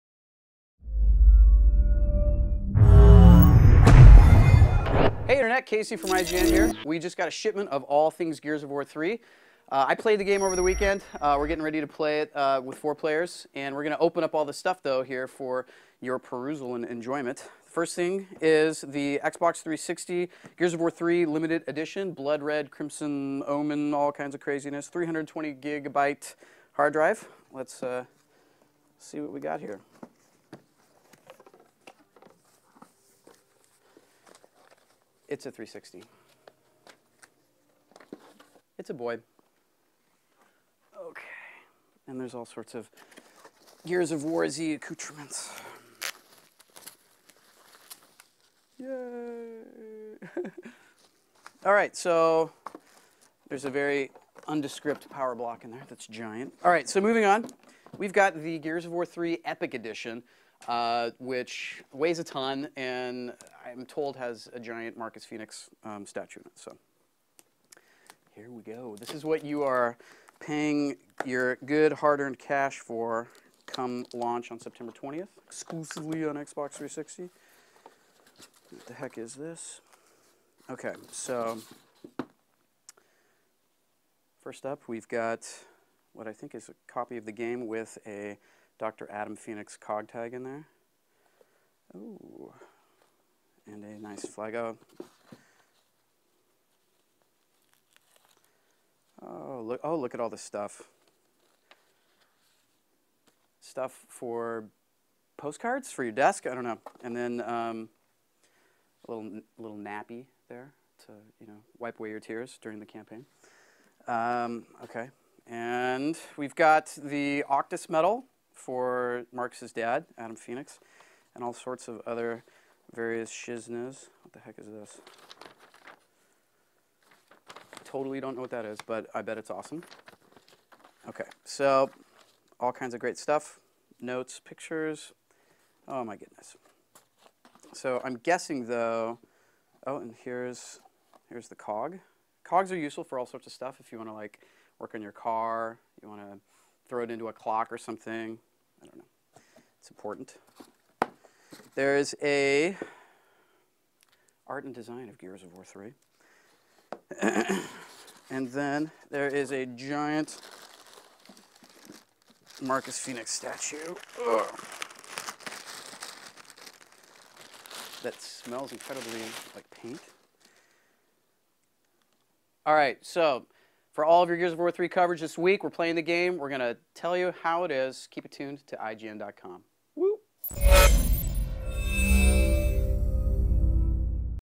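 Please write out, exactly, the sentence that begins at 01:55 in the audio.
And we've got the Octus medal for Marx's dad, Adam Fenix, and all sorts of other various shiznas.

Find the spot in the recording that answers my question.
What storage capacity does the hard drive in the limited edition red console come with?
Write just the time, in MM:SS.
00:24.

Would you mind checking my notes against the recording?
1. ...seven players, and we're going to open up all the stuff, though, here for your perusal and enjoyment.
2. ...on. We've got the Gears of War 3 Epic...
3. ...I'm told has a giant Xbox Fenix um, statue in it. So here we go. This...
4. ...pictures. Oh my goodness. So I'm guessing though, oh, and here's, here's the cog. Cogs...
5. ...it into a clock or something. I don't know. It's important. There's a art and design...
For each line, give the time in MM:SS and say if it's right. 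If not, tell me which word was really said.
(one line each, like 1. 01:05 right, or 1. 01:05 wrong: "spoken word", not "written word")
1. 00:12 wrong: "four", not "seven"
2. 00:57 right
3. 01:03 wrong: "Marcus", not "Xbox"
4. 02:14 right
5. 02:27 right.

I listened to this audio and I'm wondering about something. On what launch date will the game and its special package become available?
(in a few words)
September 20th.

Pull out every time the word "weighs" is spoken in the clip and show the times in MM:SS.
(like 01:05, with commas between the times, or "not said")
01:01.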